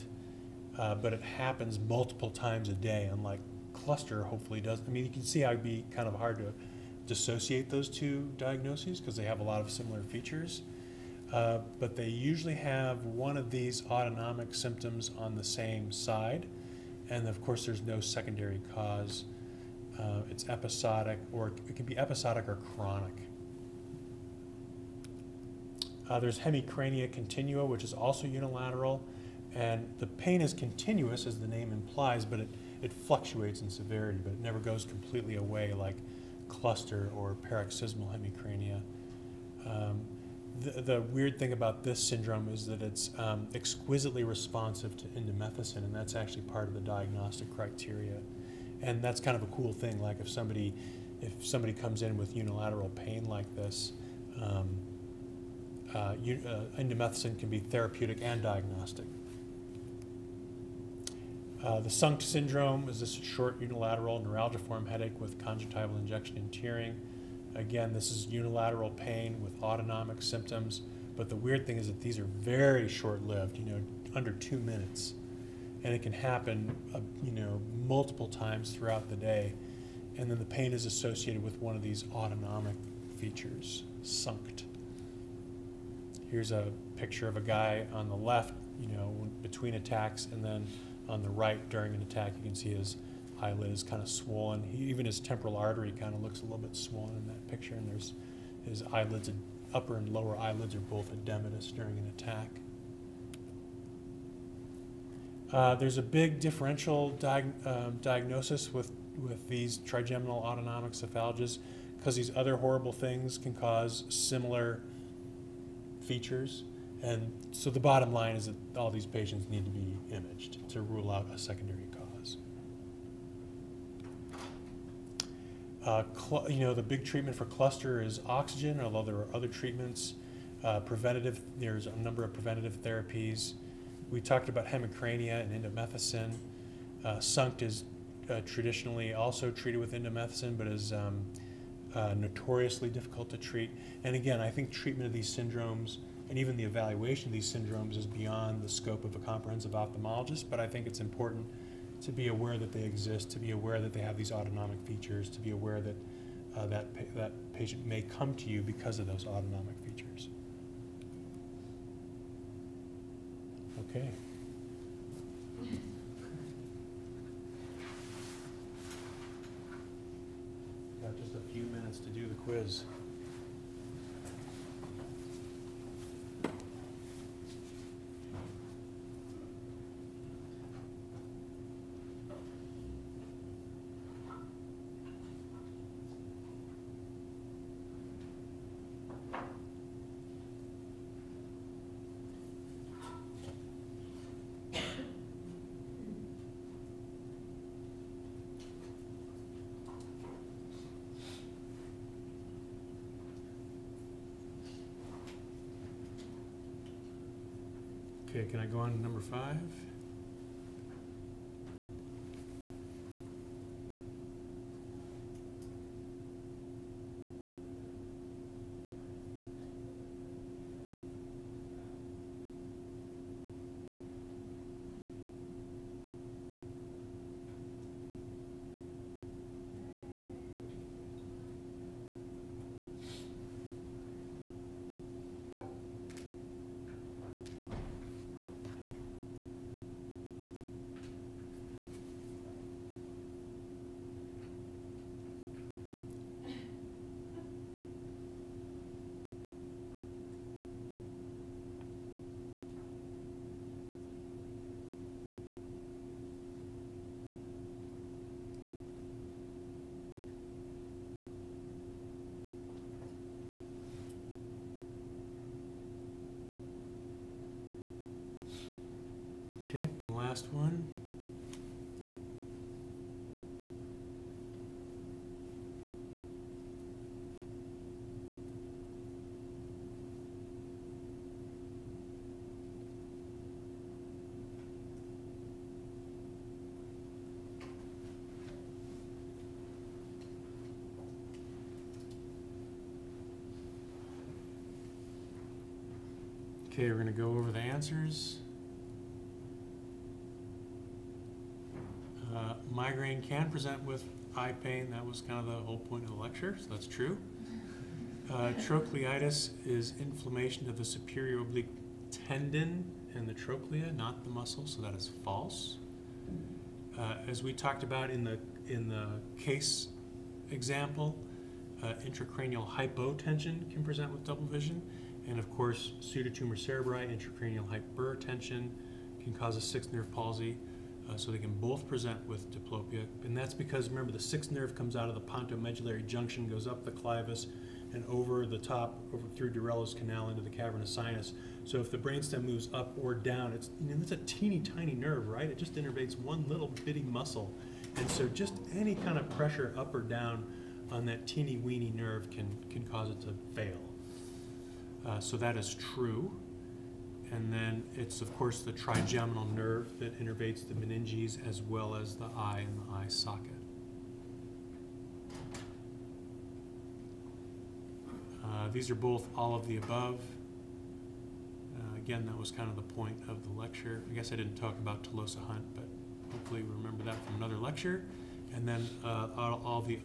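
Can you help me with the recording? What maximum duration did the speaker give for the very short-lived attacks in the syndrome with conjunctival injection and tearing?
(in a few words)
Under 2 minutes.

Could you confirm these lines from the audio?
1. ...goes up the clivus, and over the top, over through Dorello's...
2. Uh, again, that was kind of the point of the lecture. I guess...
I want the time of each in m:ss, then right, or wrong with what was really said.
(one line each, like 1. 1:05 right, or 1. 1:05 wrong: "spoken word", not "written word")
1. 5:36 right
2. 6:11 right.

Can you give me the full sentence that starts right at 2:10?
Uh, preventative, there's a number of preventative therapies.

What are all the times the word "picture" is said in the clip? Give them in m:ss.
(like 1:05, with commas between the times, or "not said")
1:26, 1:37.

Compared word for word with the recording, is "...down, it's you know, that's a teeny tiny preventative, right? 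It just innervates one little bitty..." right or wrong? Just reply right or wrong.
wrong.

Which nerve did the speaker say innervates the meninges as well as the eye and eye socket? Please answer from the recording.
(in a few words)
Trigeminal nerve.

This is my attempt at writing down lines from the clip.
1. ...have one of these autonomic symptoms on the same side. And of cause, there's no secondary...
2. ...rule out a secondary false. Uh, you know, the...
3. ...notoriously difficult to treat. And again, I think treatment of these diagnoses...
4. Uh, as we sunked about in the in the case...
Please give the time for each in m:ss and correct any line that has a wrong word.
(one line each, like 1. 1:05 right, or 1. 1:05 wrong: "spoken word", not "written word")
1. 0:12 wrong: "course", not "cause"
2. 2:00 wrong: "cause", not "false"
3. 2:22 wrong: "syndromes", not "diagnoses"
4. 5:16 wrong: "talked", not "sunked".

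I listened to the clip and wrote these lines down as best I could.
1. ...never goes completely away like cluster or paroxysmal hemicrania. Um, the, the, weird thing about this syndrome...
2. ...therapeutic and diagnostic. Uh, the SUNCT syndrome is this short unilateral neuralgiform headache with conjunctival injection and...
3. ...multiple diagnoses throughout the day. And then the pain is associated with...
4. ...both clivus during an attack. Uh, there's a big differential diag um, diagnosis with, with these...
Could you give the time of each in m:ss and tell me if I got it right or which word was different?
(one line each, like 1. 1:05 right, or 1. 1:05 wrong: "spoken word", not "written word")
1. 0:34 right
2. 0:57 right
3. 1:17 wrong: "times", not "diagnoses"
4. 1:40 wrong: "edematous", not "clivus".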